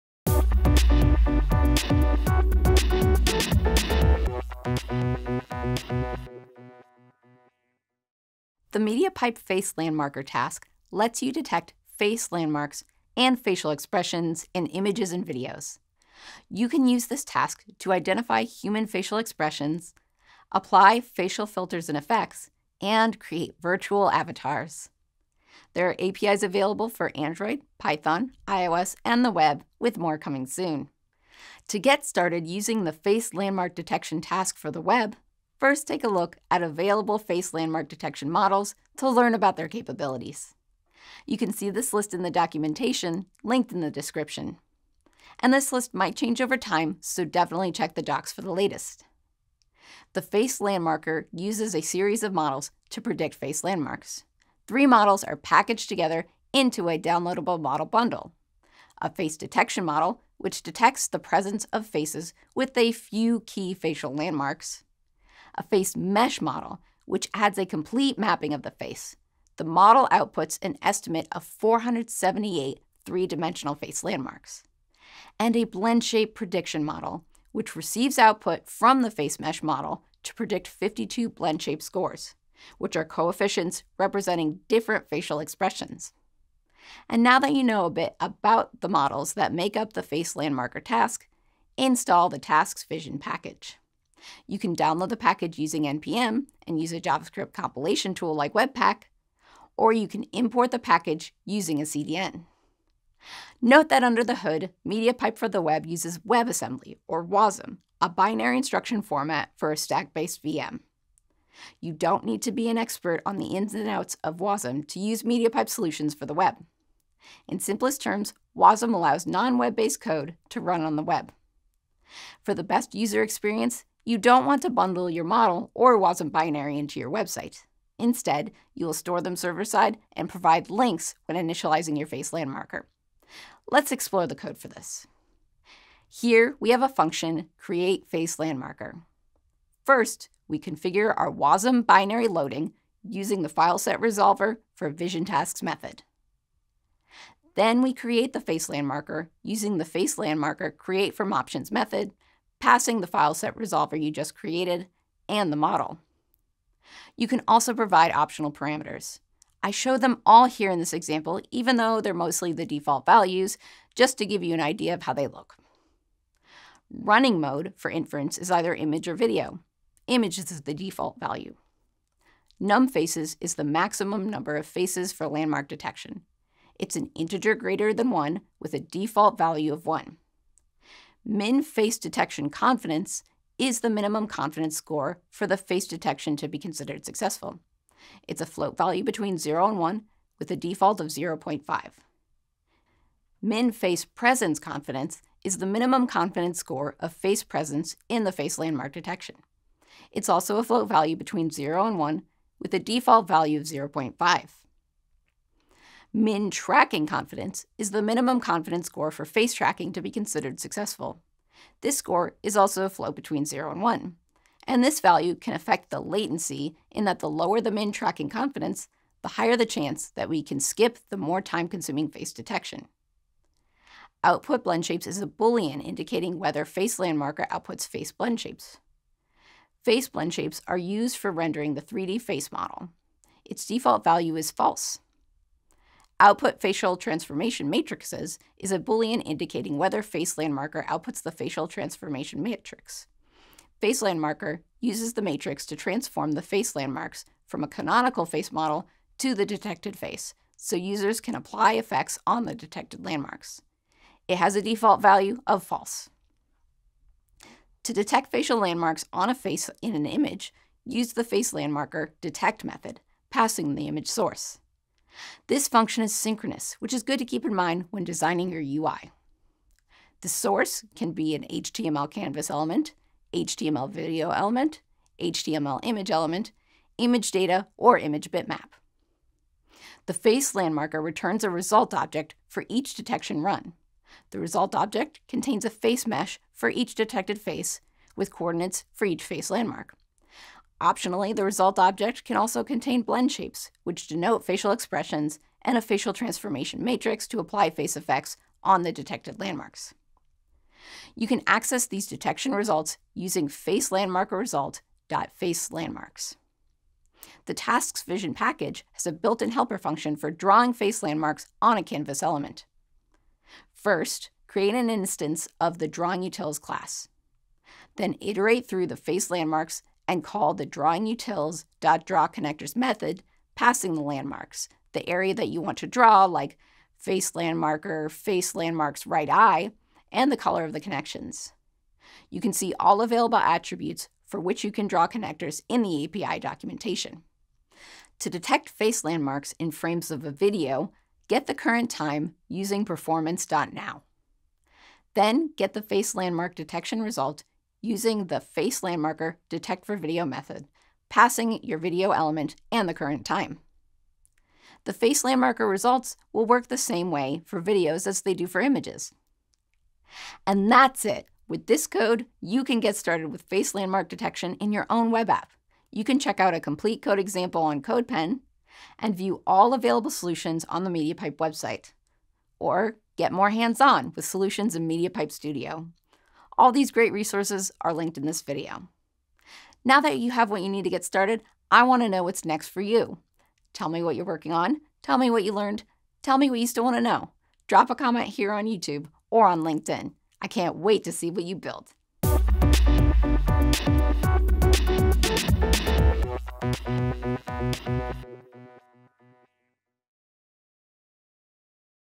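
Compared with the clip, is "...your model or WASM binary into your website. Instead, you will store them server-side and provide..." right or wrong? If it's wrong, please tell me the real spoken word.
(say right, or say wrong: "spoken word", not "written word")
right.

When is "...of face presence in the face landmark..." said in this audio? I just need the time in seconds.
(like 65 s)
196 s.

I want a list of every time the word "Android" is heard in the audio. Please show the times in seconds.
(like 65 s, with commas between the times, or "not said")
27 s.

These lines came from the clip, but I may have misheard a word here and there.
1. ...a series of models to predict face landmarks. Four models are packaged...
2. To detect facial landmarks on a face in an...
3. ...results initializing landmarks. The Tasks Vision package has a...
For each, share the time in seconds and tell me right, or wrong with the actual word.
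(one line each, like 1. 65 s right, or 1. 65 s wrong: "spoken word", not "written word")
1. 51 s wrong: "Three", not "Four"
2. 257 s right
3. 302 s wrong: "using", not "initializing".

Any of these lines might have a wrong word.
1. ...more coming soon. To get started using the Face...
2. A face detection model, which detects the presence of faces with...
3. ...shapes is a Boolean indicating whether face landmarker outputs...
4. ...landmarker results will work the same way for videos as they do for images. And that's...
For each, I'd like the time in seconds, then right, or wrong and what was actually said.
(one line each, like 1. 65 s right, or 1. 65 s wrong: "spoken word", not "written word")
1. 29 s right
2. 58 s right
3. 224 s right
4. 355 s right.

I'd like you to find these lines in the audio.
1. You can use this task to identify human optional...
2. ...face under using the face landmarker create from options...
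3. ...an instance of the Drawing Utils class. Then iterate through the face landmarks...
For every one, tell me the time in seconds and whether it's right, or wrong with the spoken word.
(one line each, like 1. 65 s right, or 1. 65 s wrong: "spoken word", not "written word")
1. 16 s wrong: "facial", not "optional"
2. 148 s wrong: "landmarker", not "under"
3. 314 s right.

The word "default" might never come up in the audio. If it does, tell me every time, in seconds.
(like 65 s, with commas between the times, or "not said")
162 s, 170 s, 178 s, 190 s, 202 s, 233 s, 254 s.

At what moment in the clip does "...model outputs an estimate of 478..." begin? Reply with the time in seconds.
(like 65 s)
69 s.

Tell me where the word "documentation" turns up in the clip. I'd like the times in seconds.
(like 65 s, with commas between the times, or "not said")
42 s, 336 s.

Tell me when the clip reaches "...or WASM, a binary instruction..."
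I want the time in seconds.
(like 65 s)
107 s.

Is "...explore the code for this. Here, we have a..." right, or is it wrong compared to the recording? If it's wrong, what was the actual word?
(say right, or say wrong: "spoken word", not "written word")
right.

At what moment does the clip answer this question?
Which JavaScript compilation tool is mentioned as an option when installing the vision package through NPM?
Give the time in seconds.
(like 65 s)
98 s.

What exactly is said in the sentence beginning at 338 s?
To detect face landmarks in frames of a video, get the current time using performance.now.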